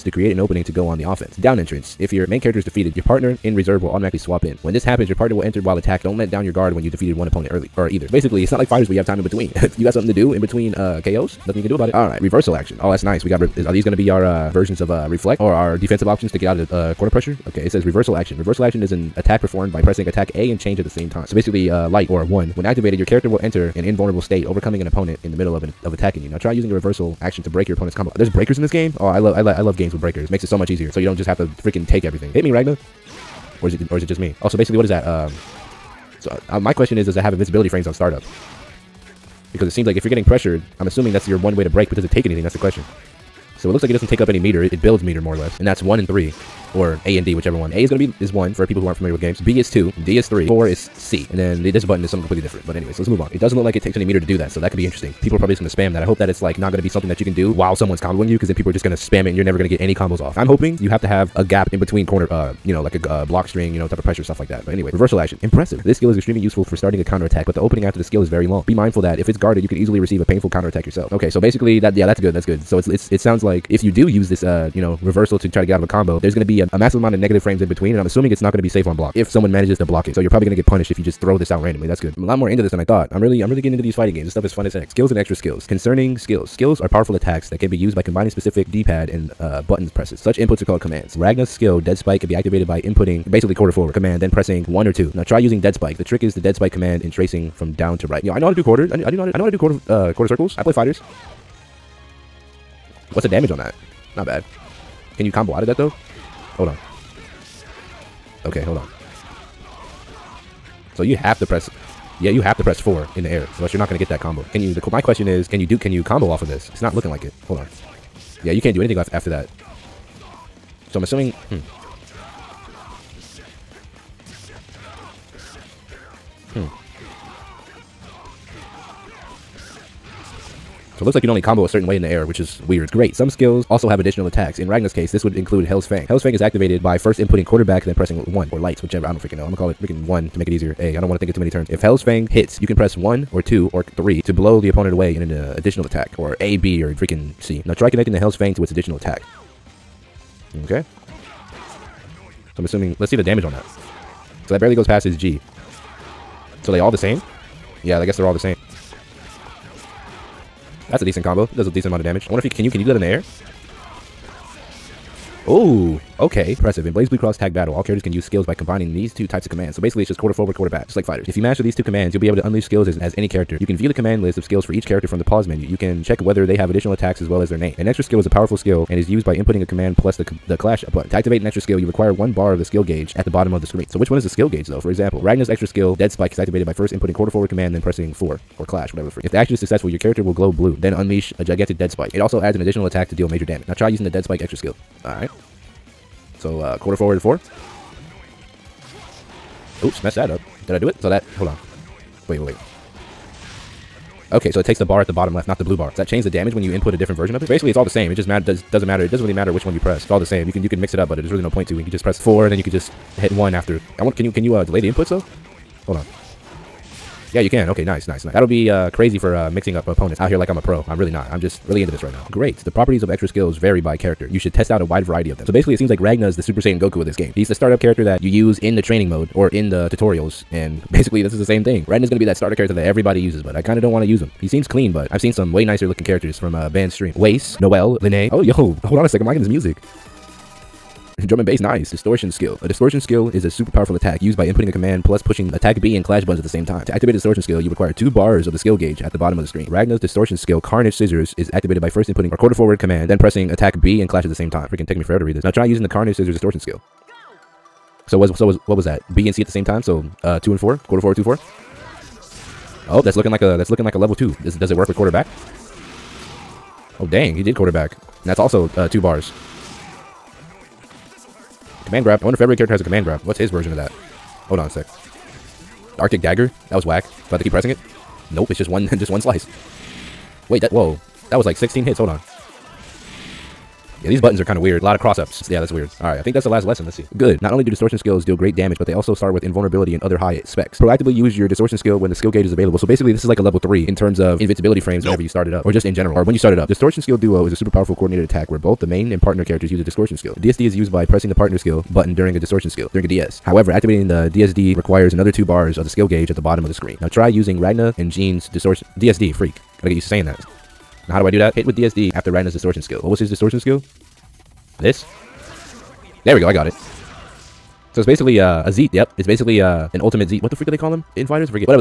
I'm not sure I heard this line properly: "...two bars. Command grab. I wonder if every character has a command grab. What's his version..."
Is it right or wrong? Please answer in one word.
right.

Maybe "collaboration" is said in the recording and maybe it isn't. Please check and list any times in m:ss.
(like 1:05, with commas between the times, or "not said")
not said.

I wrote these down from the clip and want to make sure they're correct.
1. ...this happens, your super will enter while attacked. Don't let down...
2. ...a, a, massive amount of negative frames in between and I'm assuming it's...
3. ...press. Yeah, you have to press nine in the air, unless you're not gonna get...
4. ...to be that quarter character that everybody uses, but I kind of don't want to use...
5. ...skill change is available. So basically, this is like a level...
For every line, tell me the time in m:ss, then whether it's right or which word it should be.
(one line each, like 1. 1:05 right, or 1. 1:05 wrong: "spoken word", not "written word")
1. 0:04 wrong: "partner", not "super"
2. 1:16 right
3. 1:51 wrong: "four", not "nine"
4. 3:52 wrong: "starter", not "quarter"
5. 4:52 wrong: "gauge", not "change".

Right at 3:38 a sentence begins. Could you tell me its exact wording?
That'll be uh, crazy for uh, mixing up opponents out here like I'm a pro.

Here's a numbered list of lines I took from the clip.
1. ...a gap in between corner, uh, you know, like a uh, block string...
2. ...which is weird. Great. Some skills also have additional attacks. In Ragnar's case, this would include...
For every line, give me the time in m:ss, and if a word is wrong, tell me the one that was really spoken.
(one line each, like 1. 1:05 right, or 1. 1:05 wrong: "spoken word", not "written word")
1. 1:01 right
2. 2:12 right.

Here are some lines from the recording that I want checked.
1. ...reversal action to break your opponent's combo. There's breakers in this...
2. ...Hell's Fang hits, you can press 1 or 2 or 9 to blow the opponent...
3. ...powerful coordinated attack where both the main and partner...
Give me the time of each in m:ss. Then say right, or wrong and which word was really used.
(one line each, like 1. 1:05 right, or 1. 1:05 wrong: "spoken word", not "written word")
1. 0:26 right
2. 2:21 wrong: "3", not "9"
3. 4:57 right.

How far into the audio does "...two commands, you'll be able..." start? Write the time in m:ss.
2:51.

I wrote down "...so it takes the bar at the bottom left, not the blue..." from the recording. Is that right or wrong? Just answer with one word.
right.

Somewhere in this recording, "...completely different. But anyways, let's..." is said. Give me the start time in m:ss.
0:52.